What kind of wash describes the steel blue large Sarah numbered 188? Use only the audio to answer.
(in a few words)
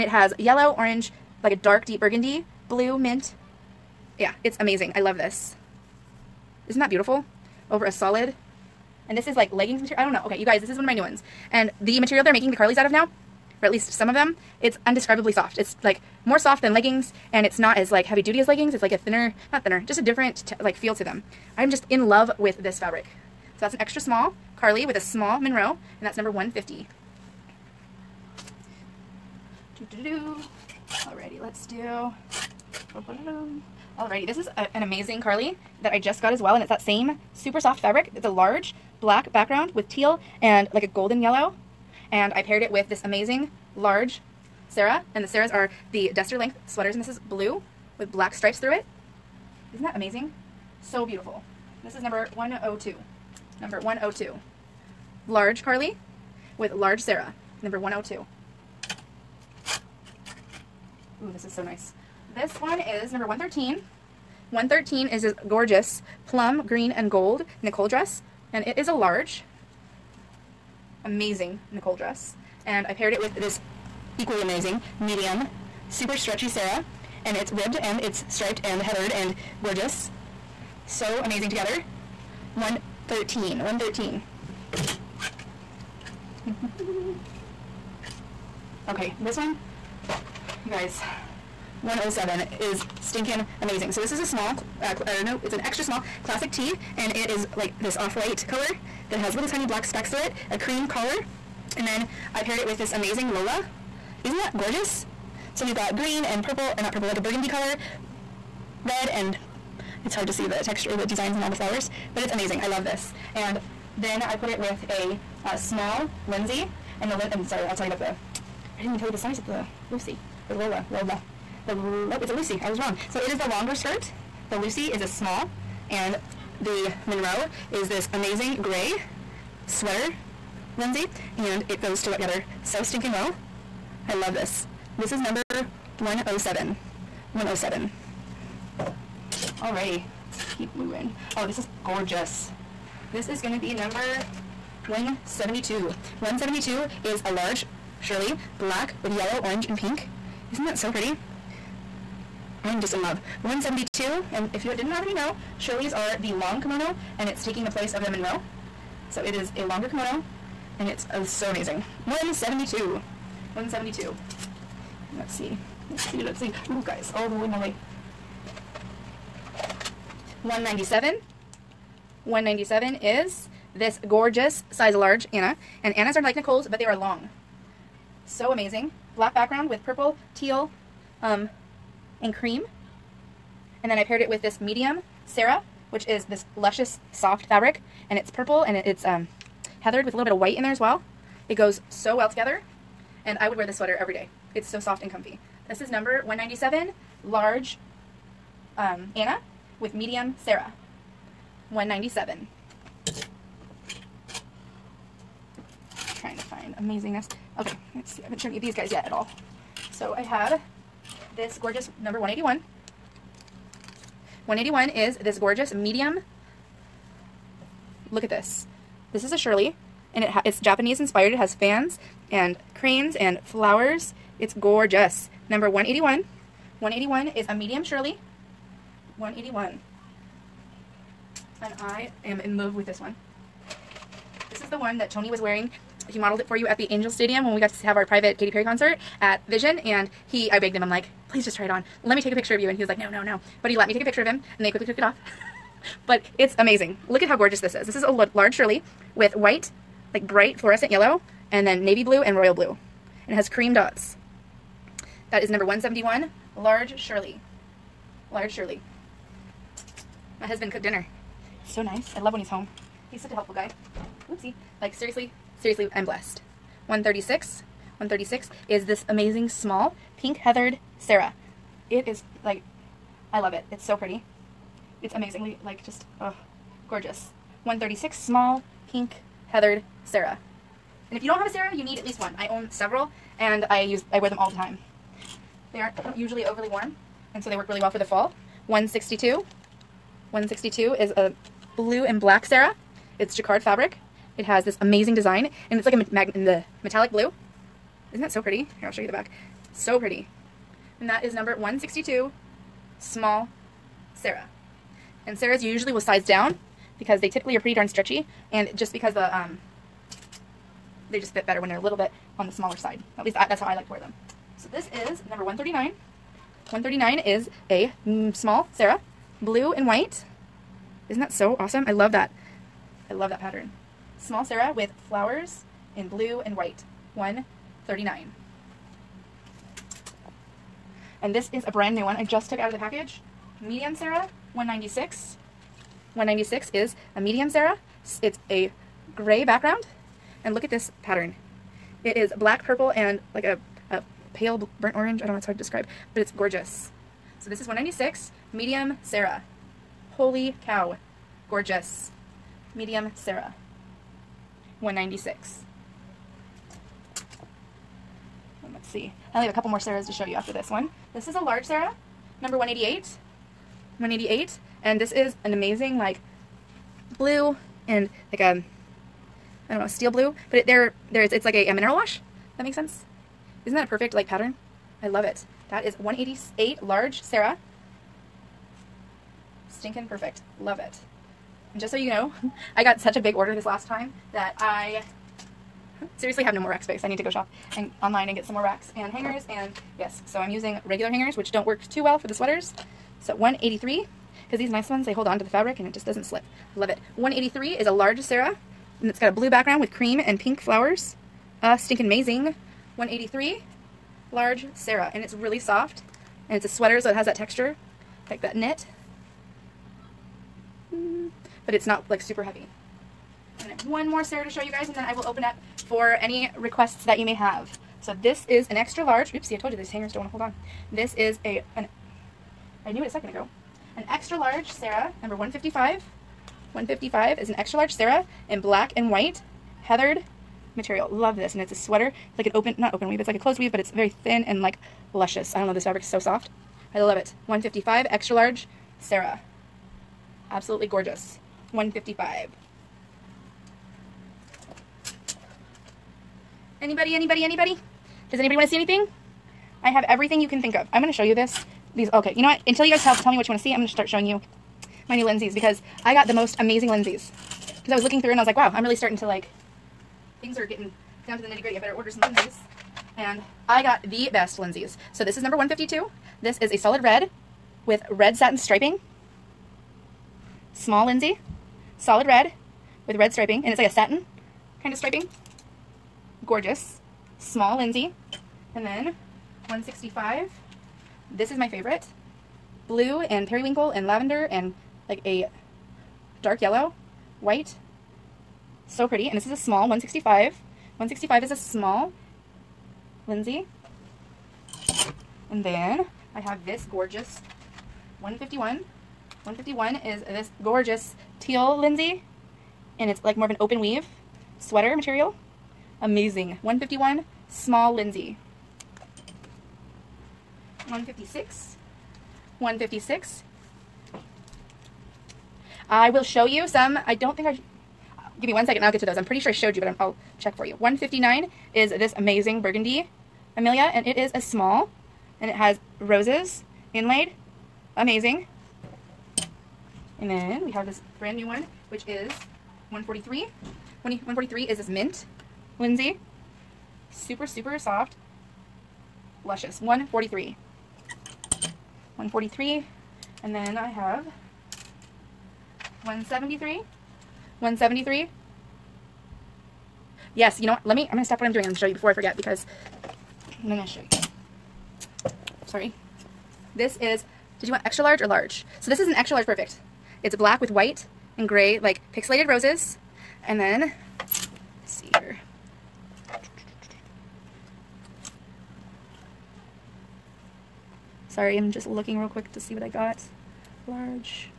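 Mineral wash.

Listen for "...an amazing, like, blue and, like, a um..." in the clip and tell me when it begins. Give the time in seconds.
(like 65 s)
365 s.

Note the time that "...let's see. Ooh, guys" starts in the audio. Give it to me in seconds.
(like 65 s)
166 s.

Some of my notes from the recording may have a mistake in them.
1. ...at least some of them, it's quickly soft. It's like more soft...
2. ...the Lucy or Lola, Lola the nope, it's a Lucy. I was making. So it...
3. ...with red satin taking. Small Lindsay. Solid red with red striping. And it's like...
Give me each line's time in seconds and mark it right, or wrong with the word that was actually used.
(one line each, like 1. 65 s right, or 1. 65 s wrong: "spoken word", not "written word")
1. 13 s wrong: "undescribably", not "quickly"
2. 119 s wrong: "wrong", not "making"
3. 467 s wrong: "striping", not "taking".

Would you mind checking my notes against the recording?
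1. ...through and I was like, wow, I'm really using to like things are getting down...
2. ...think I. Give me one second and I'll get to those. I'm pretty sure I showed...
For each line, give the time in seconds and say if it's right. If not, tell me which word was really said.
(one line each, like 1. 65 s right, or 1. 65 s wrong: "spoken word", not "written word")
1. 458 s wrong: "starting", not "using"
2. 517 s right.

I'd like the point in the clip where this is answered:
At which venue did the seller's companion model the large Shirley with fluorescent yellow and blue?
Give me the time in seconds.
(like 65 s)
236 s.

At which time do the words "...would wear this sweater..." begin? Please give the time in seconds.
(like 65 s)
193 s.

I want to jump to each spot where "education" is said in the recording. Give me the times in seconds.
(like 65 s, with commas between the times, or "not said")
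not said.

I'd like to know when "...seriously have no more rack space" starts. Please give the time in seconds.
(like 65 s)
386 s.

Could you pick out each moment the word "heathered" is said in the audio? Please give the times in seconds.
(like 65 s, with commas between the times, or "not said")
78 s, 189 s, 270 s, 279 s, 429 s.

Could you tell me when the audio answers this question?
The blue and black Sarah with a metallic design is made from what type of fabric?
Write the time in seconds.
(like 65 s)
293 s.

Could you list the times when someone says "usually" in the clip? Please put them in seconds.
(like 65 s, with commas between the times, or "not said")
286 s, 305 s.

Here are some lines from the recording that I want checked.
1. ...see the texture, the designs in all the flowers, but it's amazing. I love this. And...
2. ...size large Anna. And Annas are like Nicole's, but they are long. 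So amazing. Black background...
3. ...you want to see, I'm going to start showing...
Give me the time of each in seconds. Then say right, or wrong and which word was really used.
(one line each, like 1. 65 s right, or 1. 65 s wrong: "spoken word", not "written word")
1. 110 s right
2. 174 s right
3. 453 s right.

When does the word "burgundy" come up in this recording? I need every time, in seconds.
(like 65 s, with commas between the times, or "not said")
2 s, 107 s, 522 s.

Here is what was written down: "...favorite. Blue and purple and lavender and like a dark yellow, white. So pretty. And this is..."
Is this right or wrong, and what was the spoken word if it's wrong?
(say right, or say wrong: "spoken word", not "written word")
wrong: "periwinkle", not "purple".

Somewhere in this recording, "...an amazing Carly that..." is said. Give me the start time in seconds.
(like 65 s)
34 s.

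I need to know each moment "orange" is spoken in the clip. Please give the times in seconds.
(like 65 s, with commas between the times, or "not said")
0 s, 149 s, 344 s.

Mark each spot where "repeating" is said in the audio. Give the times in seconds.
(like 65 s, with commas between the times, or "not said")
not said.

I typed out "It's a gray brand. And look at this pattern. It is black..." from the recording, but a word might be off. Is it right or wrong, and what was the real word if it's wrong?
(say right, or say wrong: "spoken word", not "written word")
wrong: "background", not "brand".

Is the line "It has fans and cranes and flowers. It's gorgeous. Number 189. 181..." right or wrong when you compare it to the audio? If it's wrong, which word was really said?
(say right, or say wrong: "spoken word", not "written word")
wrong: "181", not "189".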